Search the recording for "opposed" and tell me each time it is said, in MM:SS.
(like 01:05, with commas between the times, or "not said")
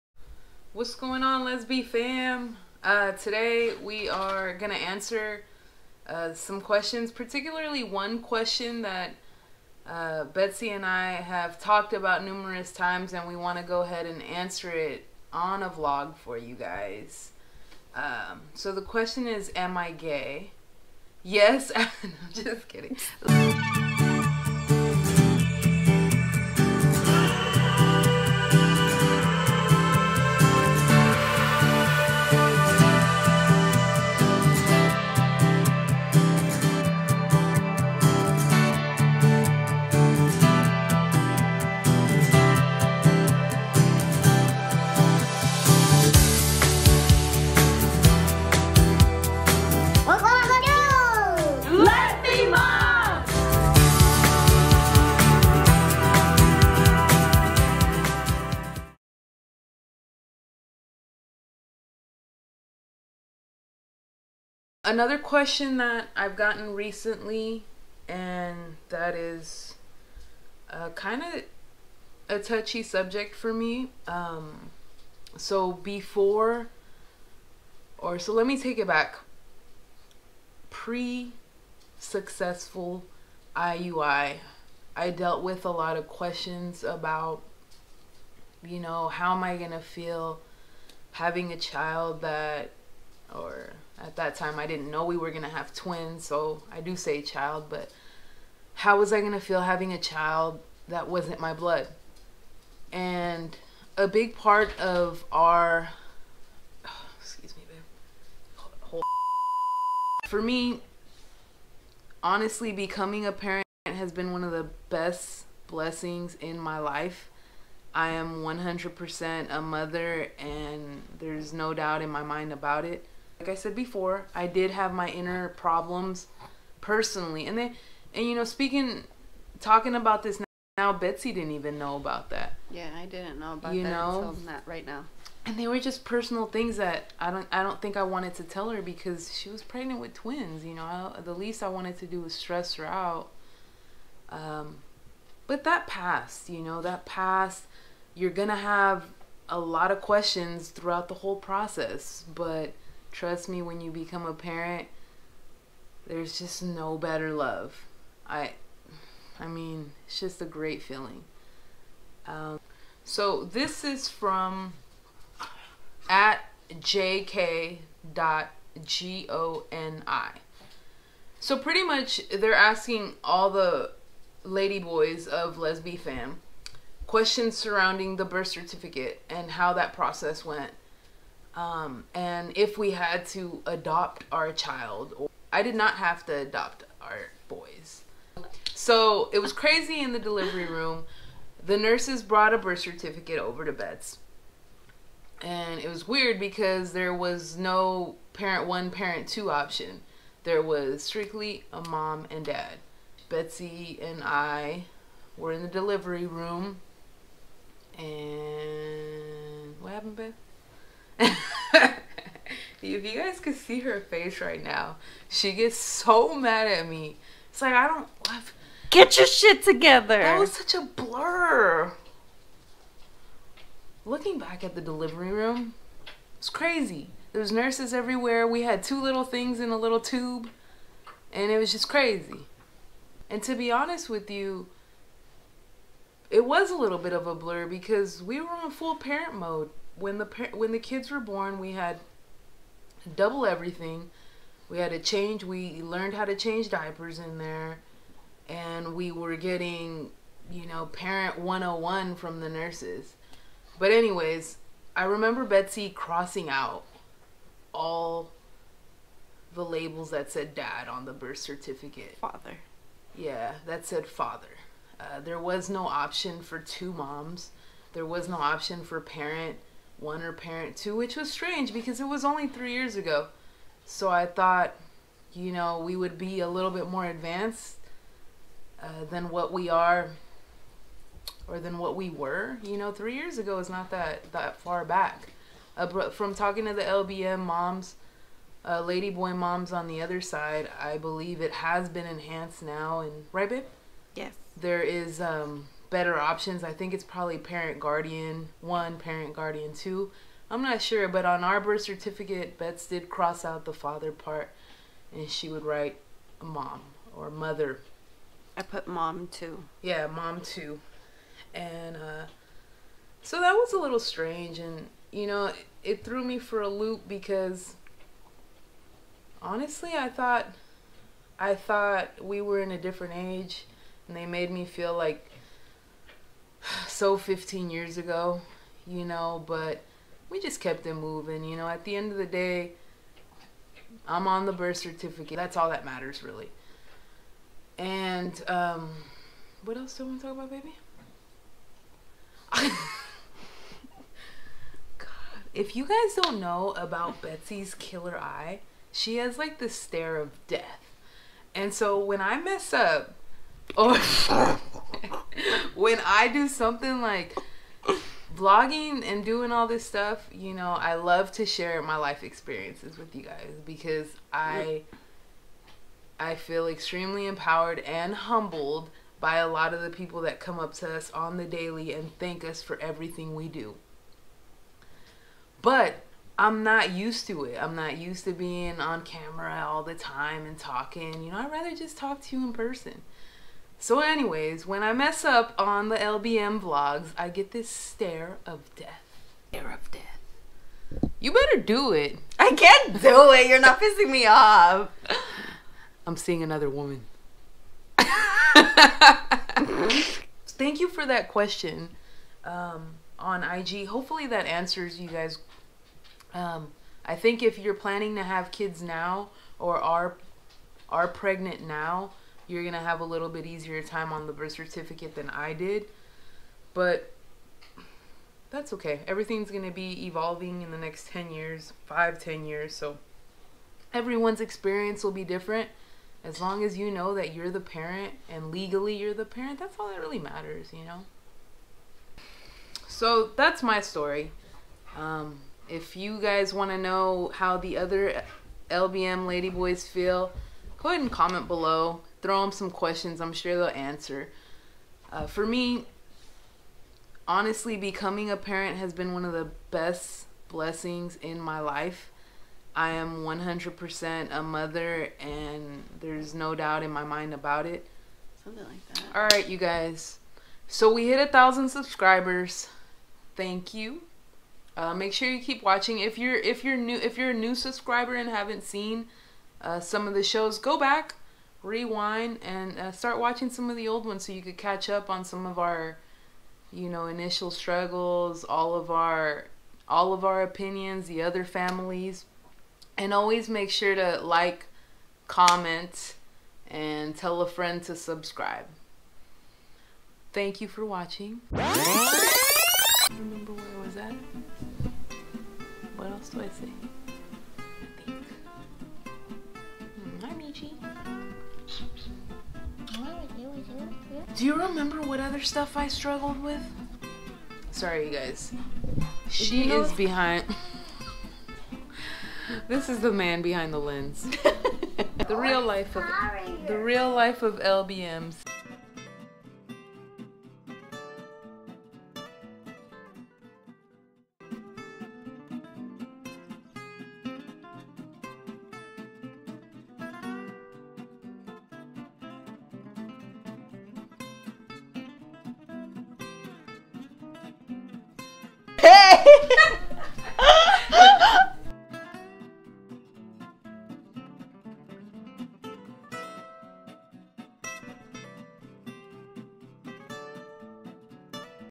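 not said.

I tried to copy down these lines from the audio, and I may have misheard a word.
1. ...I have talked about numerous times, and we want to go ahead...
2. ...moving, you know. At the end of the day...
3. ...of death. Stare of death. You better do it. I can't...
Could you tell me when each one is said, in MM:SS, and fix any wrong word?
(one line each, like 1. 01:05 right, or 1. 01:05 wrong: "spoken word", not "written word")
1. 00:10 right
2. 05:30 right
3. 06:28 right.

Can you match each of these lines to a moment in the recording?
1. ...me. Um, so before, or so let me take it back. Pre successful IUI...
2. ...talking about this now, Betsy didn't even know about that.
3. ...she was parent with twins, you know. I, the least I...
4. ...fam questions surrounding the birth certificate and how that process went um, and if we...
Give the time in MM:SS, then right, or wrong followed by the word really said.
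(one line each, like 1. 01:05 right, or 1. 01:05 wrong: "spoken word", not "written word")
1. 01:13 right
2. 02:09 right
3. 02:19 wrong: "pregnant", not "parent"
4. 02:55 right.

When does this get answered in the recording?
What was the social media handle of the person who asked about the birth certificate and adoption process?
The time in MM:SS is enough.
02:46.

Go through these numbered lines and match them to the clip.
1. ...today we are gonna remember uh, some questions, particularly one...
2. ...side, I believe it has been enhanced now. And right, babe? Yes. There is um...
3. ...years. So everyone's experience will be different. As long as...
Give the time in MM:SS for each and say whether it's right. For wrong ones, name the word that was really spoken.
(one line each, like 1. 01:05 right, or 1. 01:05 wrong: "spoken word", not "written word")
1. 00:03 wrong: "answer", not "remember"
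2. 04:50 right
3. 07:02 right.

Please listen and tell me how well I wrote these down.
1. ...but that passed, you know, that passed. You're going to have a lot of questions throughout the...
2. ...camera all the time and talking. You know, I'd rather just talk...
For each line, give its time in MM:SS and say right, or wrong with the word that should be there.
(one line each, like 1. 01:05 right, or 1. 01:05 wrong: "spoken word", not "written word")
1. 02:25 right
2. 06:19 right.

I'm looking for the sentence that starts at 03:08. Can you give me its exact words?
So it was crazy in the delivery room.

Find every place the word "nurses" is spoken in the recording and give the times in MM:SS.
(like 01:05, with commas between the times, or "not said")
03:11, 03:47, 04:12.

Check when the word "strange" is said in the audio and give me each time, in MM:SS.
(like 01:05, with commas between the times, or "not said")
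04:31, 05:13.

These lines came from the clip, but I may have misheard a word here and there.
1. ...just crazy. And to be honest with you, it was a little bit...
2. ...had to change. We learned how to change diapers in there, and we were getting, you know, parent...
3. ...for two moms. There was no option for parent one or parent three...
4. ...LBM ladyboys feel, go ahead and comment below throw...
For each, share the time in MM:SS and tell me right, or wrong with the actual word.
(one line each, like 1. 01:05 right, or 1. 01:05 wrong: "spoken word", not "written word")
1. 03:51 right
2. 04:04 right
3. 04:26 wrong: "two", not "three"
4. 07:18 right.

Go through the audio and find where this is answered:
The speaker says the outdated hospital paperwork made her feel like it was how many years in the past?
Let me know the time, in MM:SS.
05:27.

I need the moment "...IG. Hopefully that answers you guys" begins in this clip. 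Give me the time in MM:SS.
06:43.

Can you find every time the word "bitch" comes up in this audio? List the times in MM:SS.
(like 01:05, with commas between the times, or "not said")
not said.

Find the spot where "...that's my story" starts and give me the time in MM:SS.
07:13.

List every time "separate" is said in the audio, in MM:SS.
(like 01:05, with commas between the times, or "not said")
not said.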